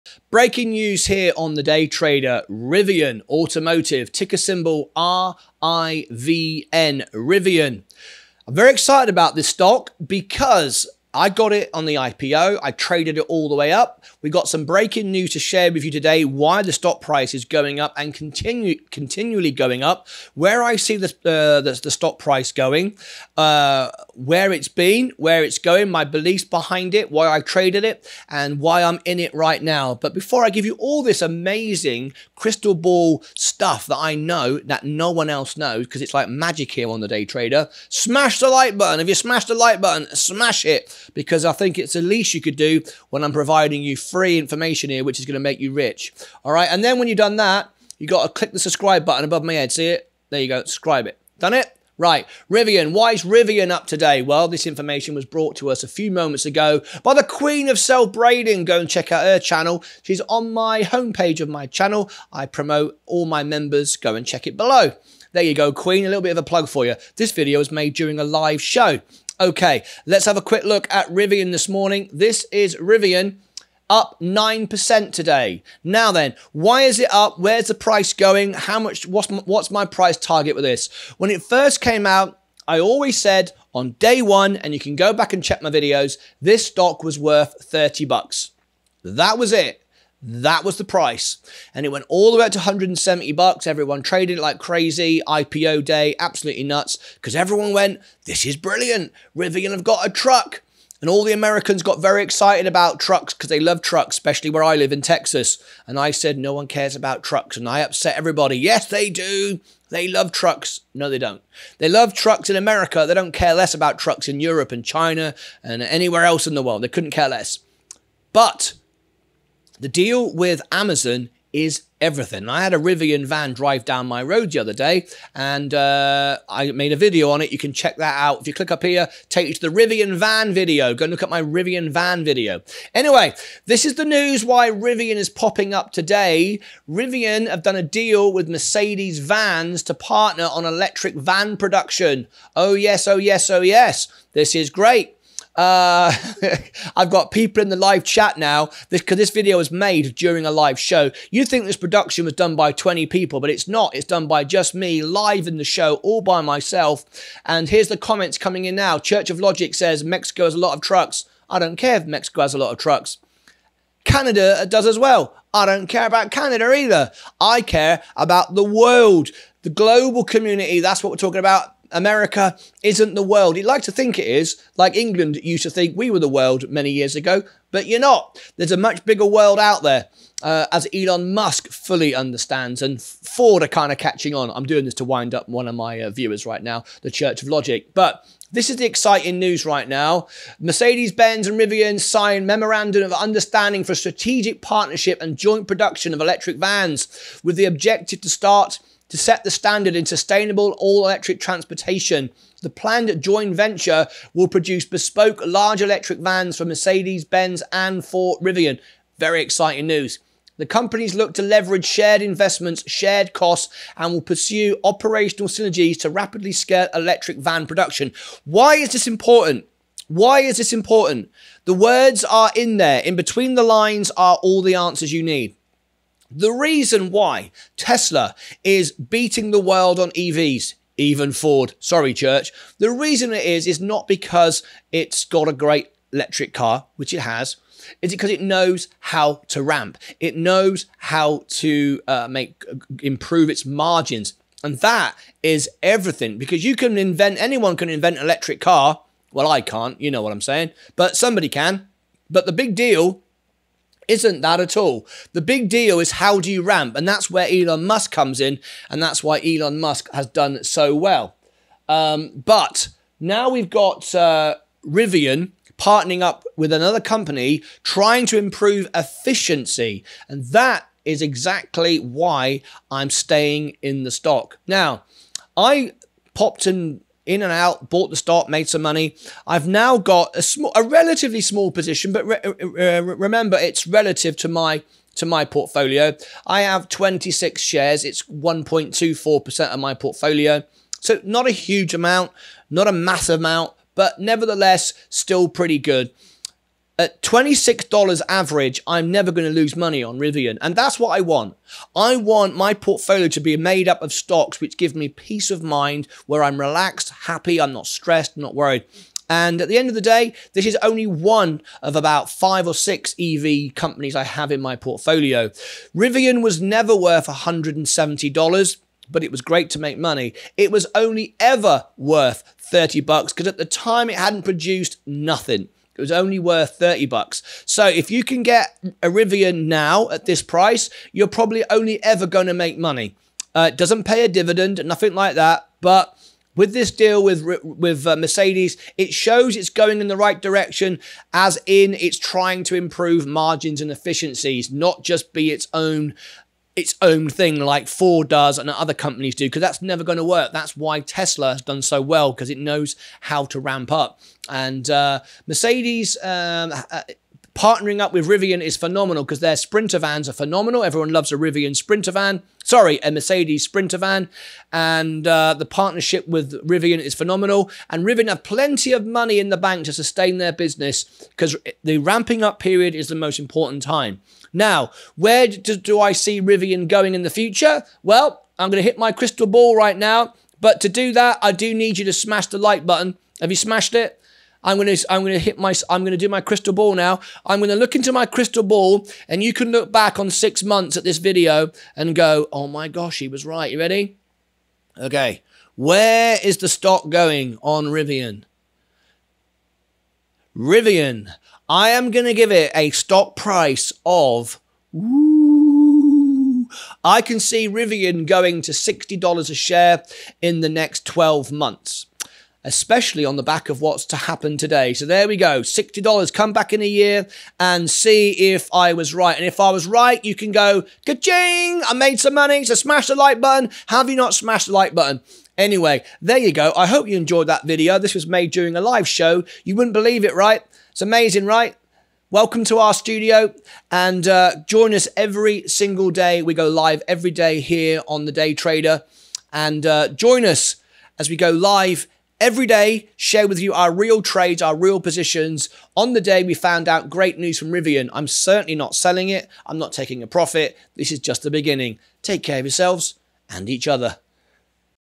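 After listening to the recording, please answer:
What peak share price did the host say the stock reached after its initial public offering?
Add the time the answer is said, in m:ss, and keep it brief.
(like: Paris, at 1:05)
$170, at 1:32.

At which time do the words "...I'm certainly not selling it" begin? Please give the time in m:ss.
7:28.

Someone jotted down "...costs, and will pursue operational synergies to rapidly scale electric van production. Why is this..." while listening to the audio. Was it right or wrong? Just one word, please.
right.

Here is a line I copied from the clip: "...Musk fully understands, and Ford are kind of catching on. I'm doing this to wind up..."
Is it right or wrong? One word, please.
right.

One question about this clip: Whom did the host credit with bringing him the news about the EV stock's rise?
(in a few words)
Queen of Cell Braiding.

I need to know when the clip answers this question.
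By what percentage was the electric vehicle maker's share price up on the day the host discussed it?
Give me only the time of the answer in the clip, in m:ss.
1:14.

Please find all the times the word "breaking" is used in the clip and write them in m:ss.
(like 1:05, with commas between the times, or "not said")
0:00, 0:14.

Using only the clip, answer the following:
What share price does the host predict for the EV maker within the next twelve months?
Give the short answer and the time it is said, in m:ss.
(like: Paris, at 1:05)
$60, at 6:48.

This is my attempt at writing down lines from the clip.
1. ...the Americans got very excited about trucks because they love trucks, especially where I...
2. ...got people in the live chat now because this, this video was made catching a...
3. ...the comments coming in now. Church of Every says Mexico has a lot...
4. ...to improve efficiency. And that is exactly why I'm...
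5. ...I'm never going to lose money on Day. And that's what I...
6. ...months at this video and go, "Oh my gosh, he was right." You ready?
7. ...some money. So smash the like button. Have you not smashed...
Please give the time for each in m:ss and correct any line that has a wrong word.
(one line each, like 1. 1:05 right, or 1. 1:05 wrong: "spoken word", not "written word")
1. 1:41 right
2. 2:27 wrong: "during", not "catching"
3. 2:37 wrong: "Logic", not "Every"
4. 4:28 right
5. 4:58 wrong: "Rivian", not "Day"
6. 6:30 right
7. 7:02 right.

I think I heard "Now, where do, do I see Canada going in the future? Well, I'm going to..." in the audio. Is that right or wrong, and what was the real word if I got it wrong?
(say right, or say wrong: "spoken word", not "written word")
wrong: "Rivian", not "Canada".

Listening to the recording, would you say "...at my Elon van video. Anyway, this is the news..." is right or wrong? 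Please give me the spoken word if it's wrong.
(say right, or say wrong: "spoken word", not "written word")
wrong: "Rivian", not "Elon".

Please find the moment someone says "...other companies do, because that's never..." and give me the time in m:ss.
5:48.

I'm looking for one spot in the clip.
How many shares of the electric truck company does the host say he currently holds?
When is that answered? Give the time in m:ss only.
4:46.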